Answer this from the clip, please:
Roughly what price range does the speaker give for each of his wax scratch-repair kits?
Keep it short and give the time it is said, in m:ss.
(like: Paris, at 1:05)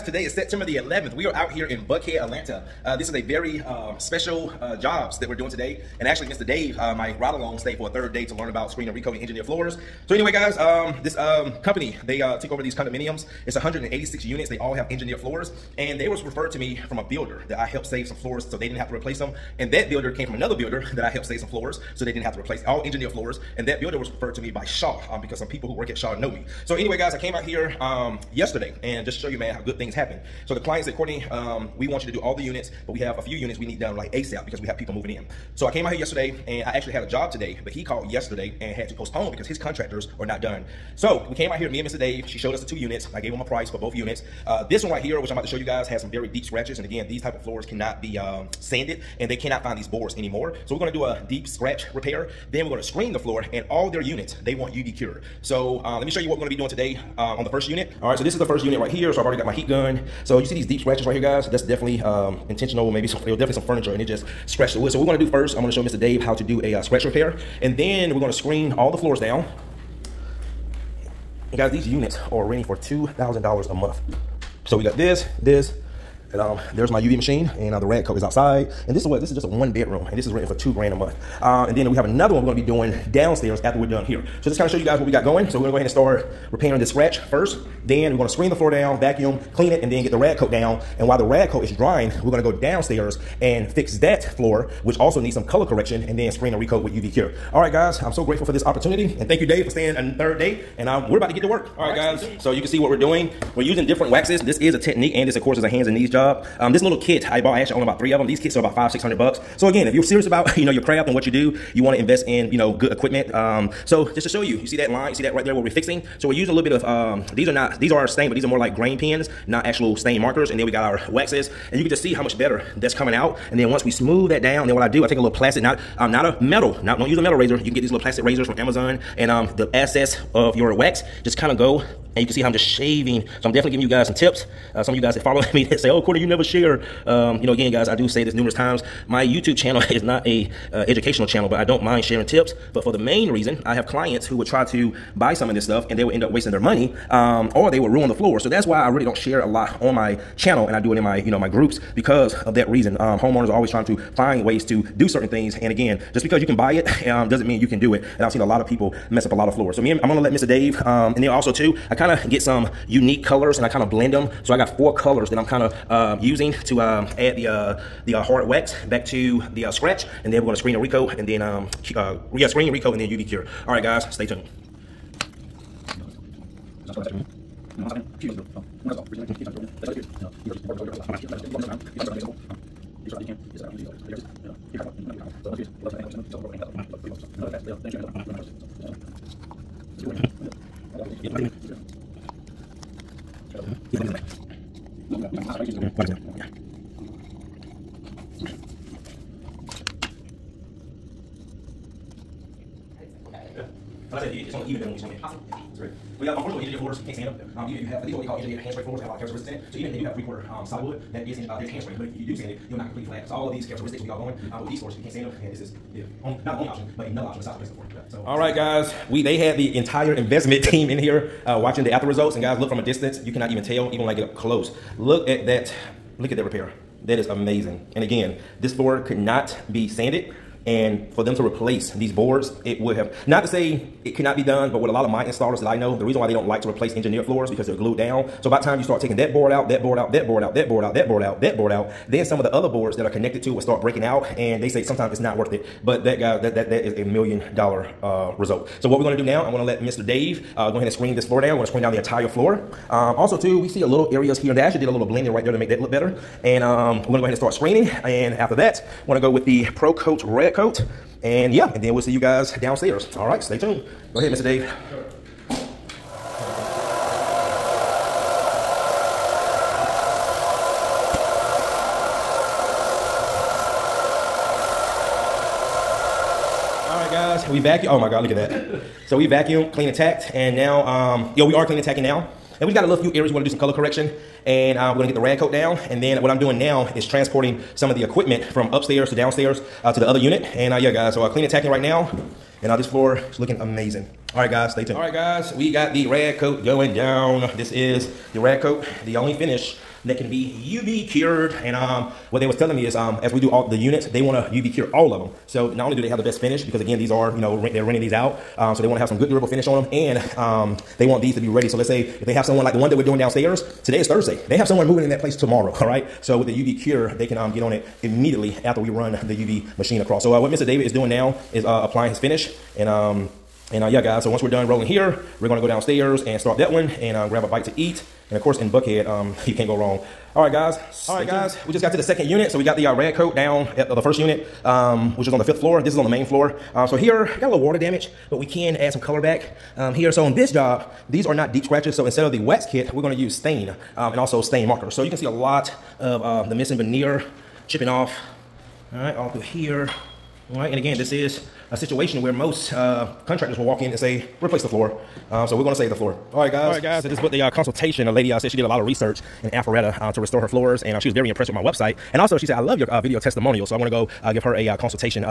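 $500 to $600, at 1:48.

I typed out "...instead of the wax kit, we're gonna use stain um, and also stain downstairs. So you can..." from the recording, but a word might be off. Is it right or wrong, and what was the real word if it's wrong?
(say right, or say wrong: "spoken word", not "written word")
wrong: "markers", not "downstairs".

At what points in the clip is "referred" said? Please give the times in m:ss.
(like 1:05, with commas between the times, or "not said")
0:16, 0:24.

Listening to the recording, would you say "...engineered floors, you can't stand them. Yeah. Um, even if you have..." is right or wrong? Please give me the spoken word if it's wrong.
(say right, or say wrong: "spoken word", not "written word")
right.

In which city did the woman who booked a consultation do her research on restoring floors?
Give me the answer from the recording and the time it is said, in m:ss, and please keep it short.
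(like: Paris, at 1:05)
Alpharetta, at 5:59.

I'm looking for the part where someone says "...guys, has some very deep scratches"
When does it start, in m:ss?
0:45.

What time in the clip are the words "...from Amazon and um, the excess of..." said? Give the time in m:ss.
2:08.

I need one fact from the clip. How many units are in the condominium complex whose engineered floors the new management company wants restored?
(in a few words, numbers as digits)
186.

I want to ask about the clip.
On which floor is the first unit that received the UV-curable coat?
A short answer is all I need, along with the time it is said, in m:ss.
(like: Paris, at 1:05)
Fifth floor, at 5:35.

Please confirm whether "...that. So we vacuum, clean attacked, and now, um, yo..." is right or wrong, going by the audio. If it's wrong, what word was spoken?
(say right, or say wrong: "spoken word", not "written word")
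right.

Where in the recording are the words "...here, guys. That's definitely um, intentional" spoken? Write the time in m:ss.
1:01.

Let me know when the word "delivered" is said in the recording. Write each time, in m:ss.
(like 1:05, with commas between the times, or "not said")
not said.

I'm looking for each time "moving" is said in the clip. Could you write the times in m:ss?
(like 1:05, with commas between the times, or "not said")
0:34, 5:14.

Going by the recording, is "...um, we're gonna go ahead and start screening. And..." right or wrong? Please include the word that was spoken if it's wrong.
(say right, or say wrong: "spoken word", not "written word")
right.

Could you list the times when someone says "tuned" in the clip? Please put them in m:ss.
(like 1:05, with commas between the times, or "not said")
2:54, 4:23, 4:54.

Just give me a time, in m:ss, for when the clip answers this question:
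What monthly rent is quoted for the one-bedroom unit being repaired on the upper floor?
1:12.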